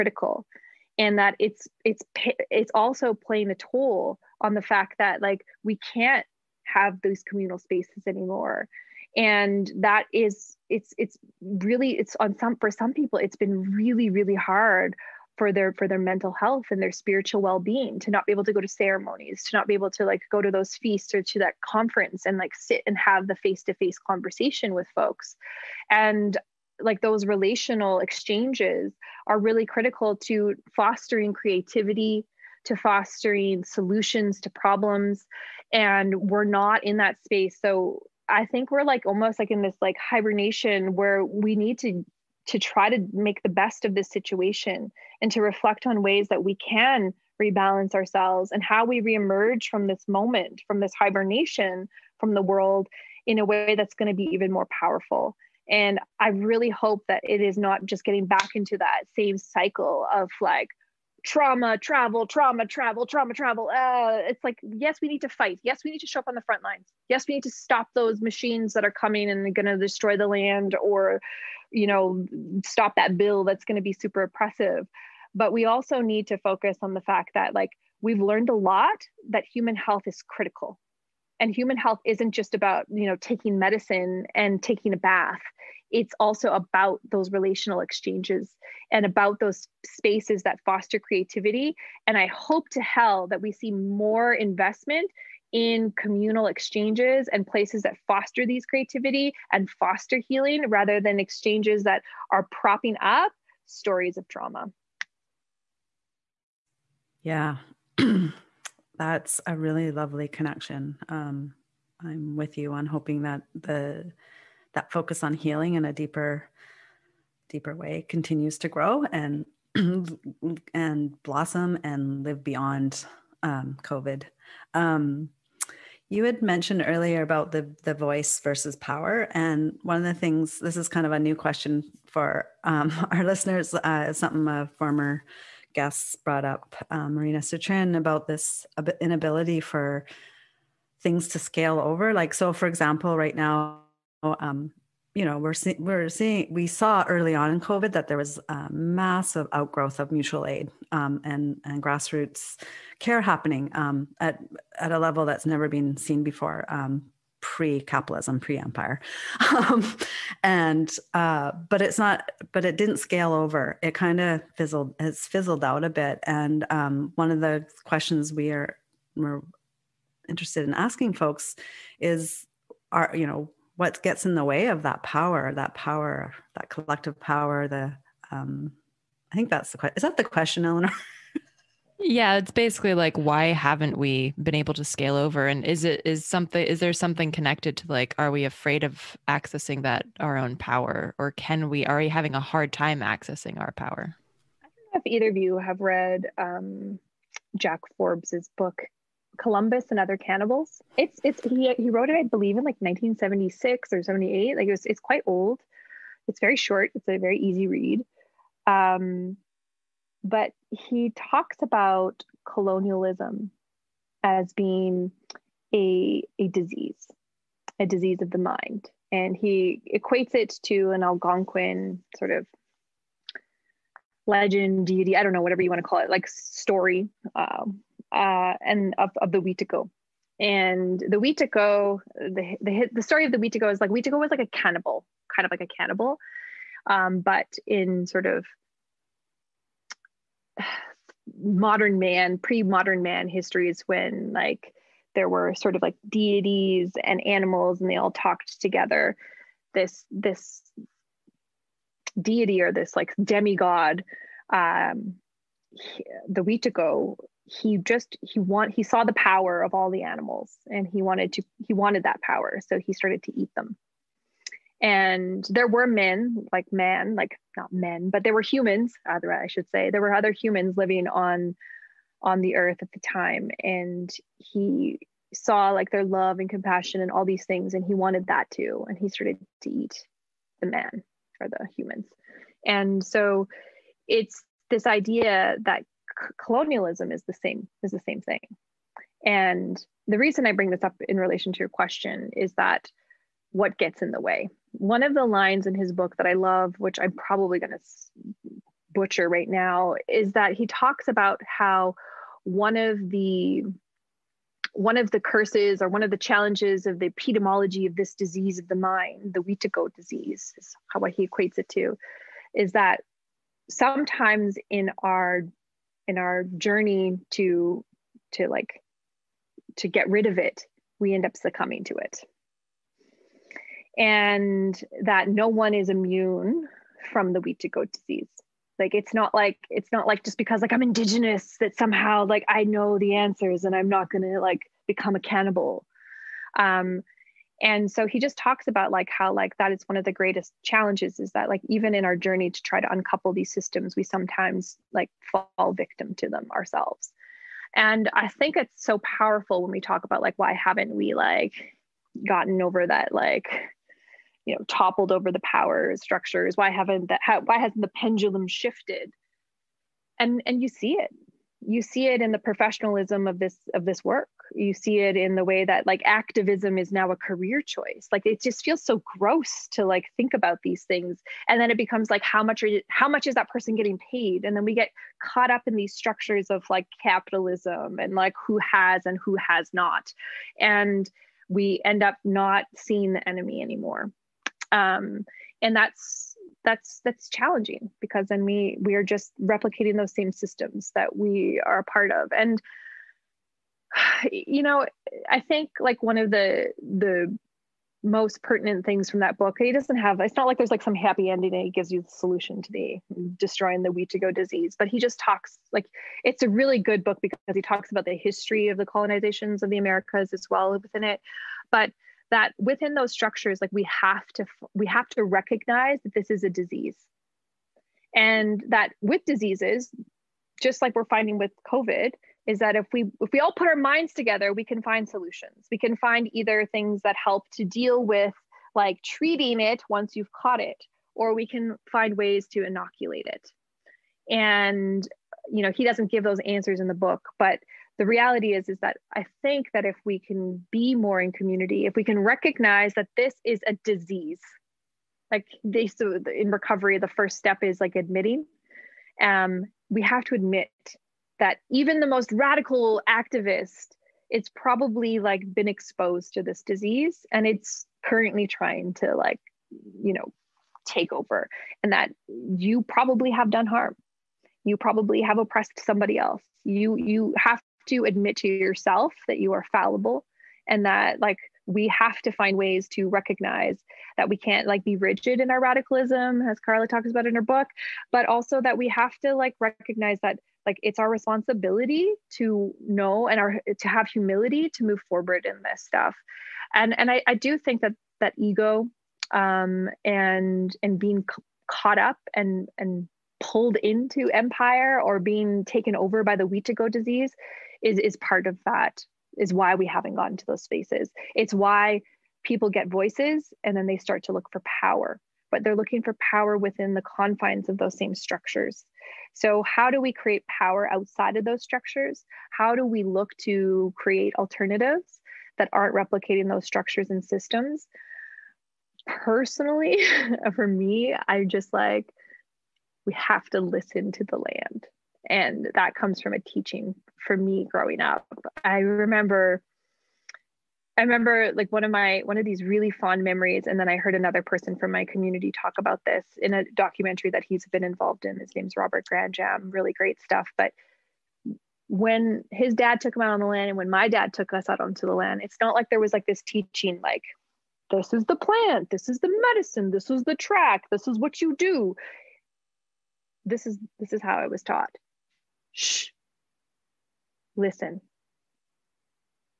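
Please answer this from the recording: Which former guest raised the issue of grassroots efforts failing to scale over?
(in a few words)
Marina Sitrin.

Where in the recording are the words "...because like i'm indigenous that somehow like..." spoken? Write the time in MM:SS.
05:30.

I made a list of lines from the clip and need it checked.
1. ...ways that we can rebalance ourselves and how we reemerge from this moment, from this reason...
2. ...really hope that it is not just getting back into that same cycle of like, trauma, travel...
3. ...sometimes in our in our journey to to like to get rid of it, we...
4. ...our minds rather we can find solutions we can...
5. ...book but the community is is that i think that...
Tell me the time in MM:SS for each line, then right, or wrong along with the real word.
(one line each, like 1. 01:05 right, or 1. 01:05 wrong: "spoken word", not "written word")
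1. 00:46 wrong: "hibernation", not "reason"
2. 00:56 right
3. 05:13 right
4. 07:03 wrong: "together", not "rather"
5. 07:16 wrong: "reality", not "community".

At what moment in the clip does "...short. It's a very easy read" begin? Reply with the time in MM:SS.
03:26.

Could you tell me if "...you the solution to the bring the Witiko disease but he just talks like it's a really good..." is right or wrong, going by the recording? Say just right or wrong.
wrong.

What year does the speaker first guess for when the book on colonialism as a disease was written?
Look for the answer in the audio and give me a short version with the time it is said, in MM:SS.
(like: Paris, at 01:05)
1976, at 03:22.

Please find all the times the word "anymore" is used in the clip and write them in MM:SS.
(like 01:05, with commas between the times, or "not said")
00:08, 06:23.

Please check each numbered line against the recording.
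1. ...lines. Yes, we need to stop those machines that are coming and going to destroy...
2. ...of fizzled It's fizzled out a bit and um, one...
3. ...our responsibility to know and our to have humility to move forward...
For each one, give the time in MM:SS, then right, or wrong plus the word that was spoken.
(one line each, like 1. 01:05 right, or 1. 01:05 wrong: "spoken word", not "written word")
1. 01:06 right
2. 02:44 right
3. 08:00 right.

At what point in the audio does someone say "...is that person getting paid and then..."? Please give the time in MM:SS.
06:13.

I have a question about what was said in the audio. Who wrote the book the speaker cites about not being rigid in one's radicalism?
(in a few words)
Carla.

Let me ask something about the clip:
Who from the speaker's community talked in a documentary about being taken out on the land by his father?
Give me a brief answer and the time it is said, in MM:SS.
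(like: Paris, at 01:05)
Robert Grandjambe, at 08:58.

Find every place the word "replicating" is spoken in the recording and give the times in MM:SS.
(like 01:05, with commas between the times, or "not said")
06:29, 08:35.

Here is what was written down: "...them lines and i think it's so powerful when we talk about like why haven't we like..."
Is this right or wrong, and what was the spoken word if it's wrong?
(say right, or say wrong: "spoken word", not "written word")
wrong: "ourselves", not "lines".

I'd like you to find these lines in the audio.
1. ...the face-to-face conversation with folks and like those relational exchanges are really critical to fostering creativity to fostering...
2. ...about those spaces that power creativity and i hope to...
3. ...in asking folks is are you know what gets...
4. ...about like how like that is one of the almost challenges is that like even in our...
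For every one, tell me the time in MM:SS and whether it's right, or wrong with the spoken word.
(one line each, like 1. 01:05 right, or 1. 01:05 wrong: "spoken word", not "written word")
1. 00:23 right
2. 01:29 wrong: "foster", not "power"
3. 02:50 right
4. 05:38 wrong: "greatest", not "almost".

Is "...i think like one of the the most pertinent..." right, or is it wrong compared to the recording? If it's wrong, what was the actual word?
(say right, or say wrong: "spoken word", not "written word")
right.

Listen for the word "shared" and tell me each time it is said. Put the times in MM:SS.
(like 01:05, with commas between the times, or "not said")
not said.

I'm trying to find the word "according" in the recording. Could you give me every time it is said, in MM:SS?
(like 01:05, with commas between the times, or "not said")
not said.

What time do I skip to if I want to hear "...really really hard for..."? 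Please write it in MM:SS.
00:13.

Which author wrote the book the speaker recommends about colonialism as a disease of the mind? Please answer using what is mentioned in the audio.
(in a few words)
Jack Forbes.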